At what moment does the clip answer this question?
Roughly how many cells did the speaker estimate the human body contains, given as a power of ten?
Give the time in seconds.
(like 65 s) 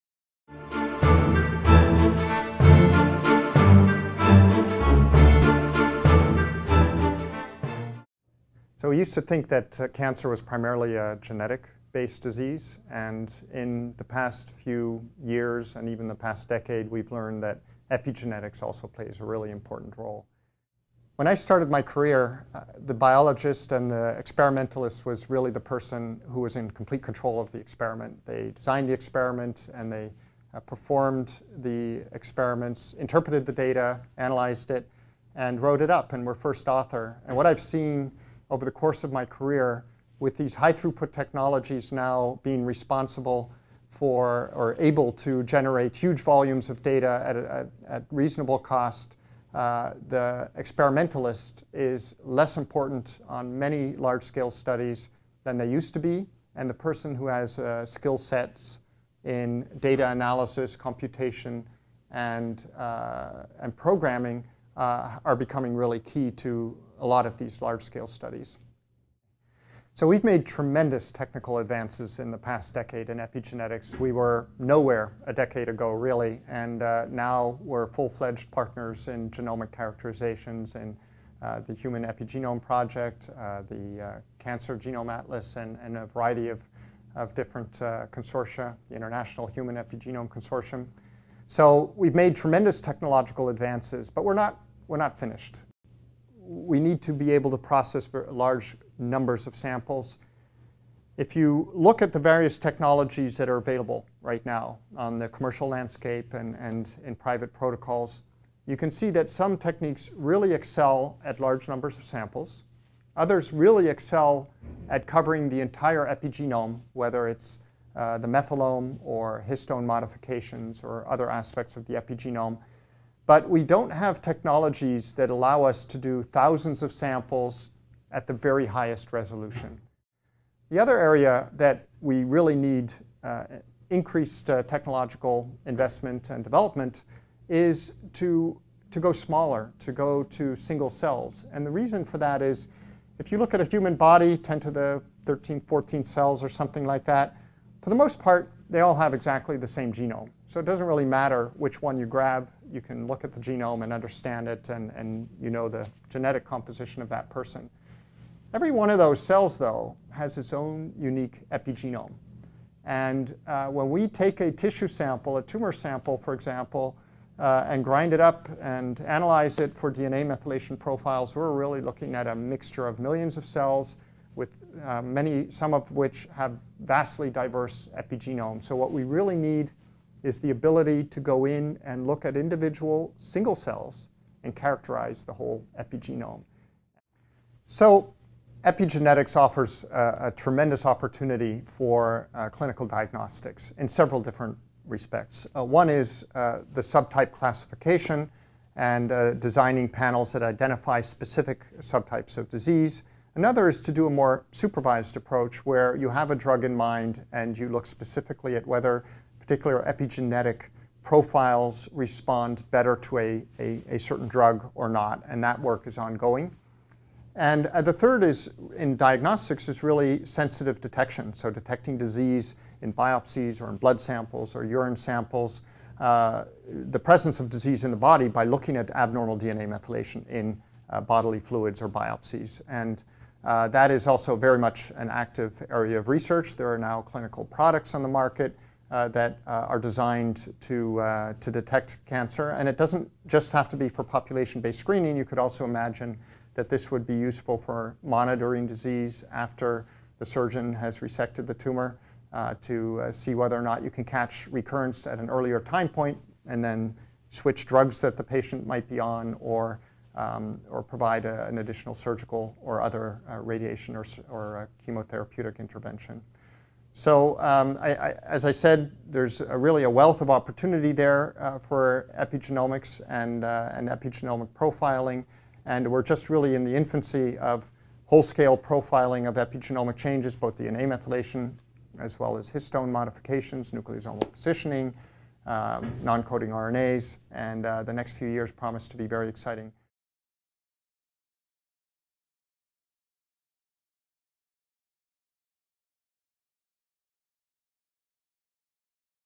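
144 s.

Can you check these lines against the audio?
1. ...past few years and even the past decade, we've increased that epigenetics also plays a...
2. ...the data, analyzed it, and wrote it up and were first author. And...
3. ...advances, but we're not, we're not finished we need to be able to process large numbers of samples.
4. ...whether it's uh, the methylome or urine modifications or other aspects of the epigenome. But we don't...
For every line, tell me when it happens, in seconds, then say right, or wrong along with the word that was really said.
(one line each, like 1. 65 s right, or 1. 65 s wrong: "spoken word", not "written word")
1. 14 s wrong: "learned", not "increased"
2. 33 s right
3. 93 s right
4. 116 s wrong: "histone", not "urine".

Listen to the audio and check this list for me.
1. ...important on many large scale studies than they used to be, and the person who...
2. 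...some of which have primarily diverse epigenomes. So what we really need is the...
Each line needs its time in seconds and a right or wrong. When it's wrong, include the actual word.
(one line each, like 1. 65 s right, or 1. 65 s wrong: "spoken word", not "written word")
1. 52 s right
2. 175 s wrong: "vastly", not "primarily".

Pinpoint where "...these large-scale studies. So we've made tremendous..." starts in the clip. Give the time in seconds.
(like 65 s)
67 s.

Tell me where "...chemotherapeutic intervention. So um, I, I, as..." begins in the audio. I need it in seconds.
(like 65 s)
264 s.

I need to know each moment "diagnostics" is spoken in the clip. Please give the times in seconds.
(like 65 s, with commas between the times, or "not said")
192 s, 218 s.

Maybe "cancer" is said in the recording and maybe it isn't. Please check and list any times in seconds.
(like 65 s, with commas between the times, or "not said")
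9 s, 84 s, 242 s.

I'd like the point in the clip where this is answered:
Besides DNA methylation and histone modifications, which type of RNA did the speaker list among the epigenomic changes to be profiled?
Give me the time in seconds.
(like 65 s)
286 s.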